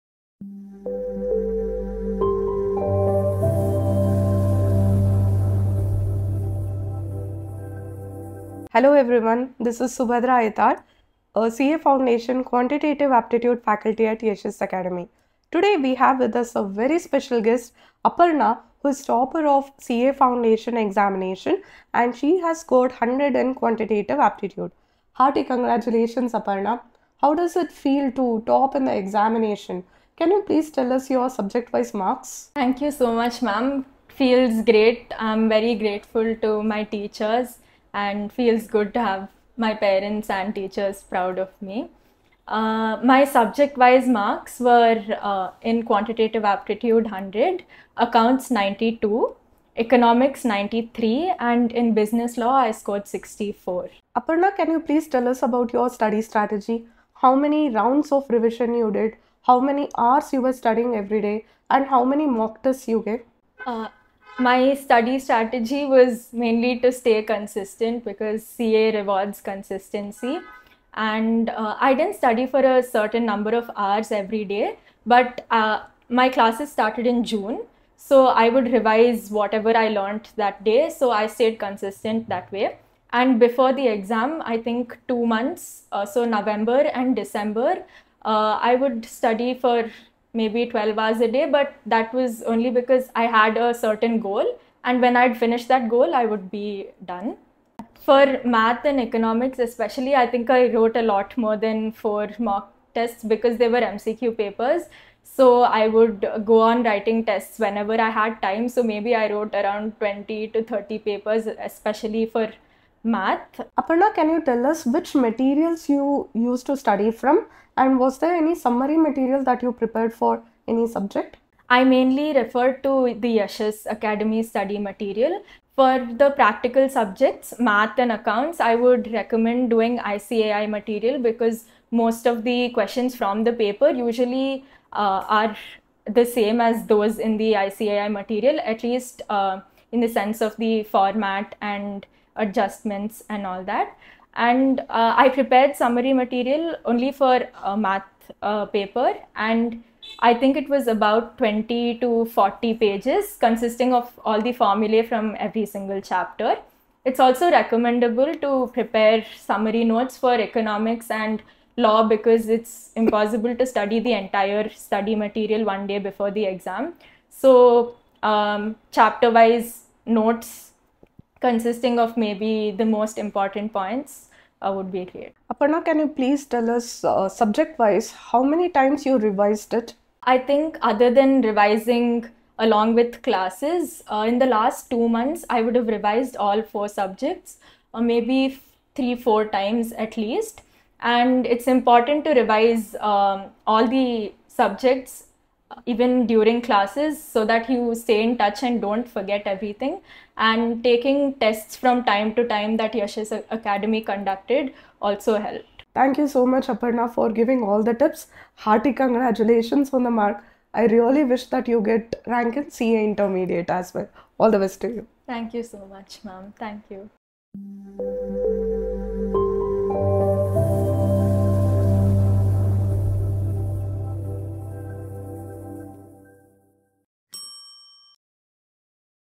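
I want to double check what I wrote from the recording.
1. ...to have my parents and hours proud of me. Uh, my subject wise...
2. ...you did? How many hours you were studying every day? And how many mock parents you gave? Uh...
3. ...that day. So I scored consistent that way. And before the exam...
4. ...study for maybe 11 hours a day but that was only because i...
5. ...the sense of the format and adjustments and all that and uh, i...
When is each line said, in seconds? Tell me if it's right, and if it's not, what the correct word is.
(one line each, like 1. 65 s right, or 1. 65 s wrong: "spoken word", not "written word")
1. 38 s wrong: "teachers", not "hours"
2. 58 s wrong: "tests", not "parents"
3. 80 s wrong: "stayed", not "scored"
4. 89 s wrong: "12", not "11"
5. 140 s right.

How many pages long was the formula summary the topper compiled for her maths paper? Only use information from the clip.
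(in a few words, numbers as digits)
20 to 40.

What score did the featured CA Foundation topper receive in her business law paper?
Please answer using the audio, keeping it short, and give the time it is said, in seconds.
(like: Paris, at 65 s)
64, at 53 s.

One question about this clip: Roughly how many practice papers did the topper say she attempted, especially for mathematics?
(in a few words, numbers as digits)
20 to 30.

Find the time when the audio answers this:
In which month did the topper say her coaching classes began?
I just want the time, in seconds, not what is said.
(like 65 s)
77 s.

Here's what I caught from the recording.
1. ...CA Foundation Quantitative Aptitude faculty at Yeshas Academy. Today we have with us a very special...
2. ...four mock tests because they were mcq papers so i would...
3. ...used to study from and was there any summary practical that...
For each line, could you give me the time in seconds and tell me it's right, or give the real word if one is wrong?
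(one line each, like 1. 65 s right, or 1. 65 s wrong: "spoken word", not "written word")
1. 11 s right
2. 101 s right
3. 116 s wrong: "material", not "practical".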